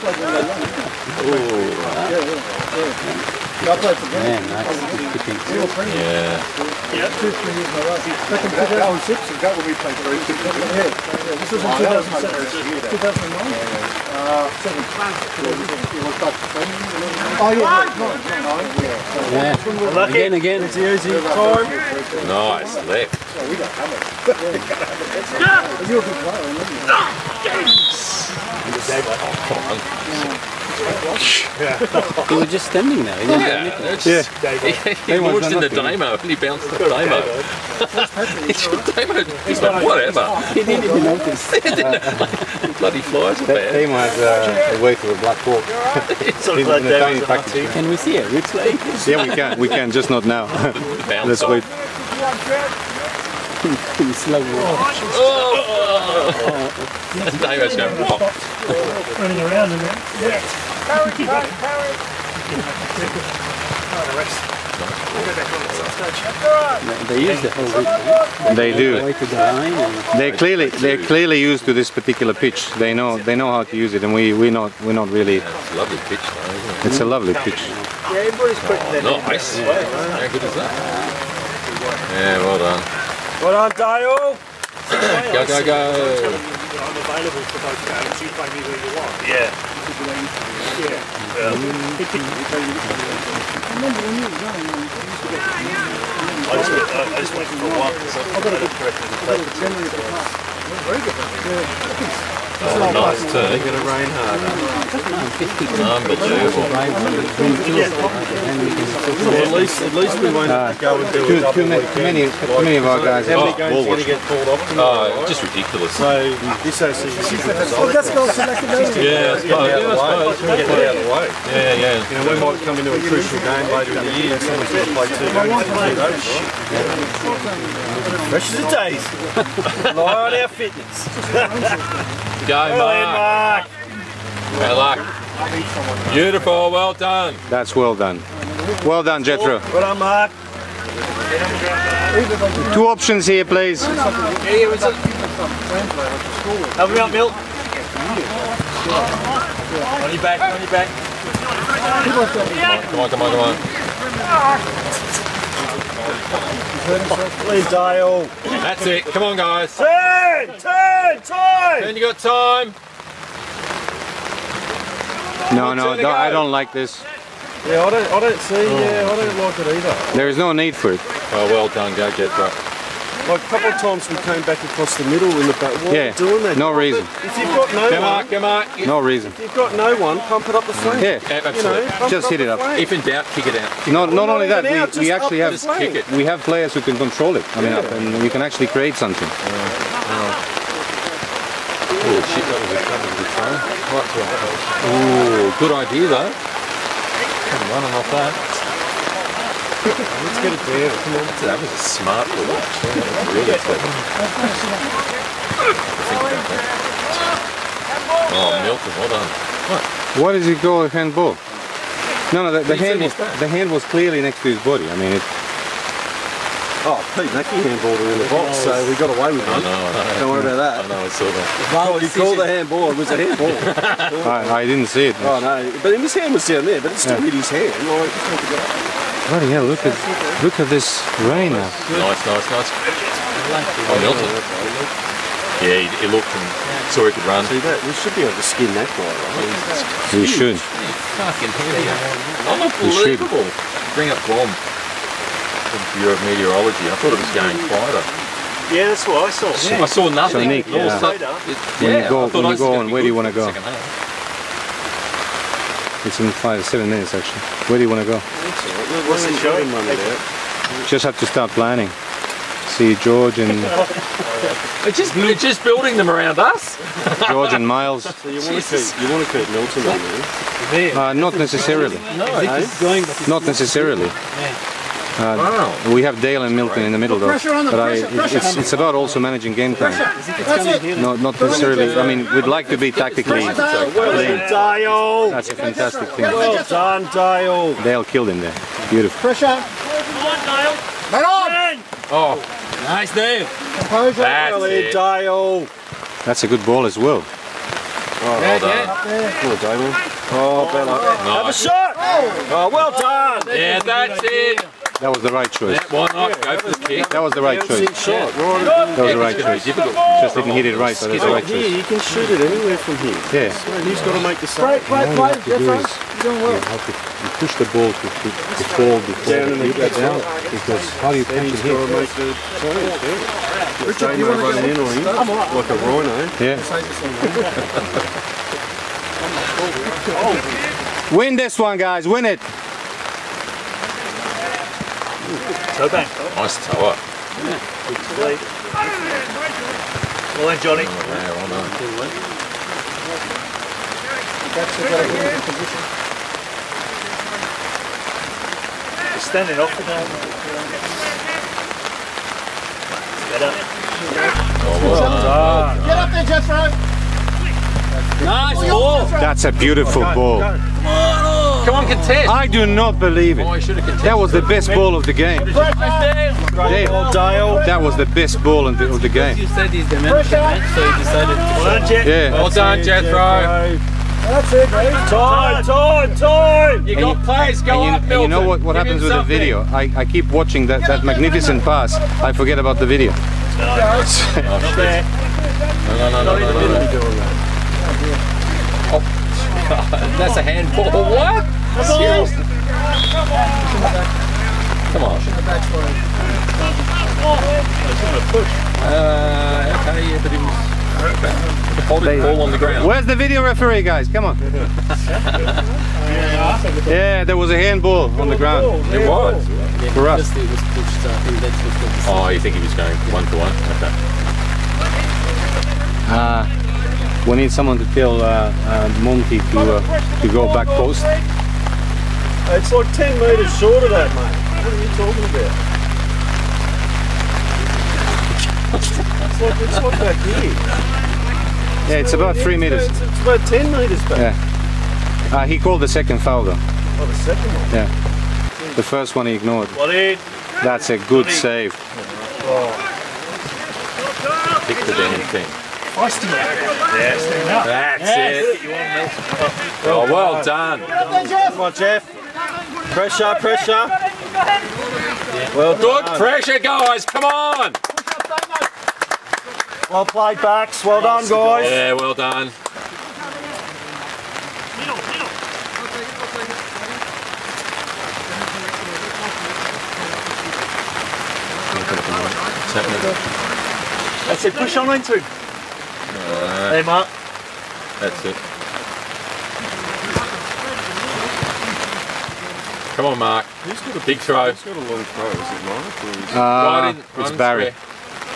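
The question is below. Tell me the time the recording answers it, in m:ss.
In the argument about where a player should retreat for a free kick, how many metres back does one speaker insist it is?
7:12.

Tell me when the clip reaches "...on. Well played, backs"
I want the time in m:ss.
7:37.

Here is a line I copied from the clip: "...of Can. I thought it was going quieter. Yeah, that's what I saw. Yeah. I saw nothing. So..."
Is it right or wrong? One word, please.
wrong.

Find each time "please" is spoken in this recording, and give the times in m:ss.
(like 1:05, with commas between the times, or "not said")
2:23, 2:37.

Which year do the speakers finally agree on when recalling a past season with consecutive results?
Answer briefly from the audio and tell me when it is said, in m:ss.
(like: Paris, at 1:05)
2007, at 0:11.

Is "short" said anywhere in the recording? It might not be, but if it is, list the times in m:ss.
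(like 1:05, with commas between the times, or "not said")
7:03.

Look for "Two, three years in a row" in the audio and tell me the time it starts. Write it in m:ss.
0:07.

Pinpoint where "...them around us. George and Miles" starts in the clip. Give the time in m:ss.
4:25.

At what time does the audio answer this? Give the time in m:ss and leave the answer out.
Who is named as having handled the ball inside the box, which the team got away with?
3:37.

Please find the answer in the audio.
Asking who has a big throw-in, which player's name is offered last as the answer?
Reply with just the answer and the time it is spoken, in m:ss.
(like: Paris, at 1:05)
Barry, at 8:07.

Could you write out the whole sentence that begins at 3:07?
and we can actually create something.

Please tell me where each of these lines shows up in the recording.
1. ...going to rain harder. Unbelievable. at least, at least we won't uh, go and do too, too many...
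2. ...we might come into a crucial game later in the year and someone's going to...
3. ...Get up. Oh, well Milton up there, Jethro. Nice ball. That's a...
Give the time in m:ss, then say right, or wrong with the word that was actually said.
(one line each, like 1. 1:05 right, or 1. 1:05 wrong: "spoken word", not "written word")
1. 1:43 right
2. 2:02 right
3. 5:53 wrong: "Get", not "Milton".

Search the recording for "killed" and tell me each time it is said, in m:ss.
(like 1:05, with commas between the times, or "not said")
4:48.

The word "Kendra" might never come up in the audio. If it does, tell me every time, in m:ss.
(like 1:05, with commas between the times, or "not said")
not said.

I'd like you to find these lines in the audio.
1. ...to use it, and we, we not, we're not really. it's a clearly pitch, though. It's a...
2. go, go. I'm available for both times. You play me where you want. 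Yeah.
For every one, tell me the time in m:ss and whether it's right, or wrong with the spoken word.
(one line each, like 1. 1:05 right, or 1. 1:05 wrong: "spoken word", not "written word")
1. 1:13 wrong: "lovely", not "clearly"
2. 1:24 wrong: "games", not "times".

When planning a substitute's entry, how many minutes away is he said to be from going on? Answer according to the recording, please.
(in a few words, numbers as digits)
5 to 7 minutes.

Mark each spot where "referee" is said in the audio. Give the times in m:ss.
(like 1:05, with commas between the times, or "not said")
6:43.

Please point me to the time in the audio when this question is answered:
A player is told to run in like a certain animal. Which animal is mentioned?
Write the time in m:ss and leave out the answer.
5:25.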